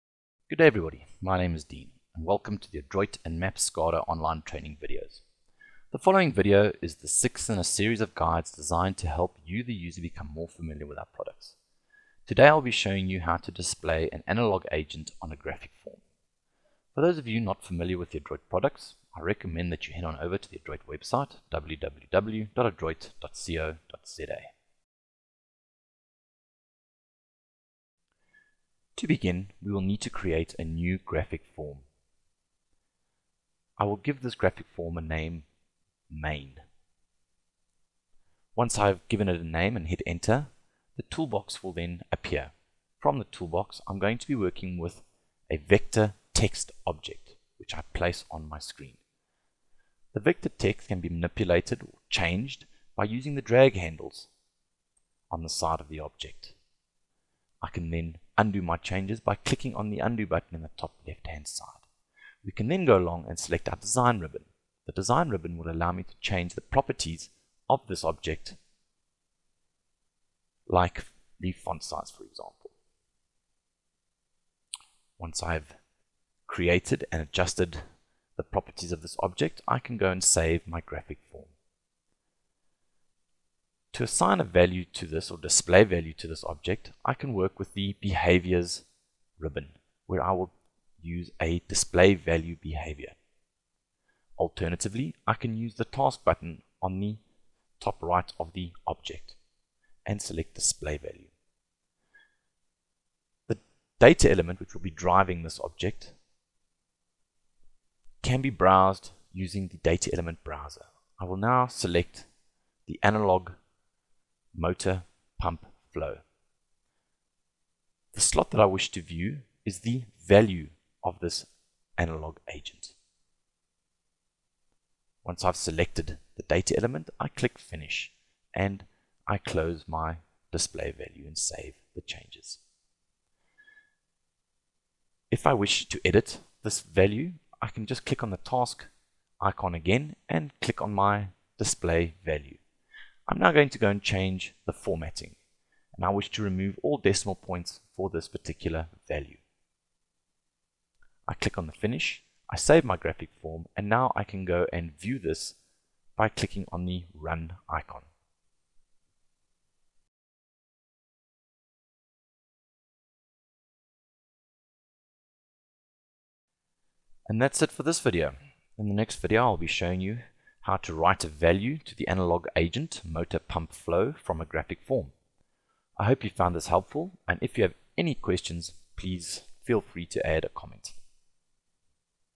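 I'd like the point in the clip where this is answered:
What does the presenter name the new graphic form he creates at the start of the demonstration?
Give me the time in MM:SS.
00:36.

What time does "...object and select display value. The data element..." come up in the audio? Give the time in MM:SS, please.
01:38.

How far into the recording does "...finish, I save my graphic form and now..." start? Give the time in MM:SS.
02:31.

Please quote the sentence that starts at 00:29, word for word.
To begin, we will need to create a new graphic form.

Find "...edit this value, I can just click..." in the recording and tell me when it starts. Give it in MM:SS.
02:16.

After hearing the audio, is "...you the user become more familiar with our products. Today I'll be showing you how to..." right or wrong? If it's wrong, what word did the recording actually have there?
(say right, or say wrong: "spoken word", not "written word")
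right.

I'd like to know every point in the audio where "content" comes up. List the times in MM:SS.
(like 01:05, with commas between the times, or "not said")
not said.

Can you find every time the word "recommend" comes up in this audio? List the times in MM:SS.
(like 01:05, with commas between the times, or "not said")
00:19.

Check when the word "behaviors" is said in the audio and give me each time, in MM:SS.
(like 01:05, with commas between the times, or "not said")
01:27, 01:32.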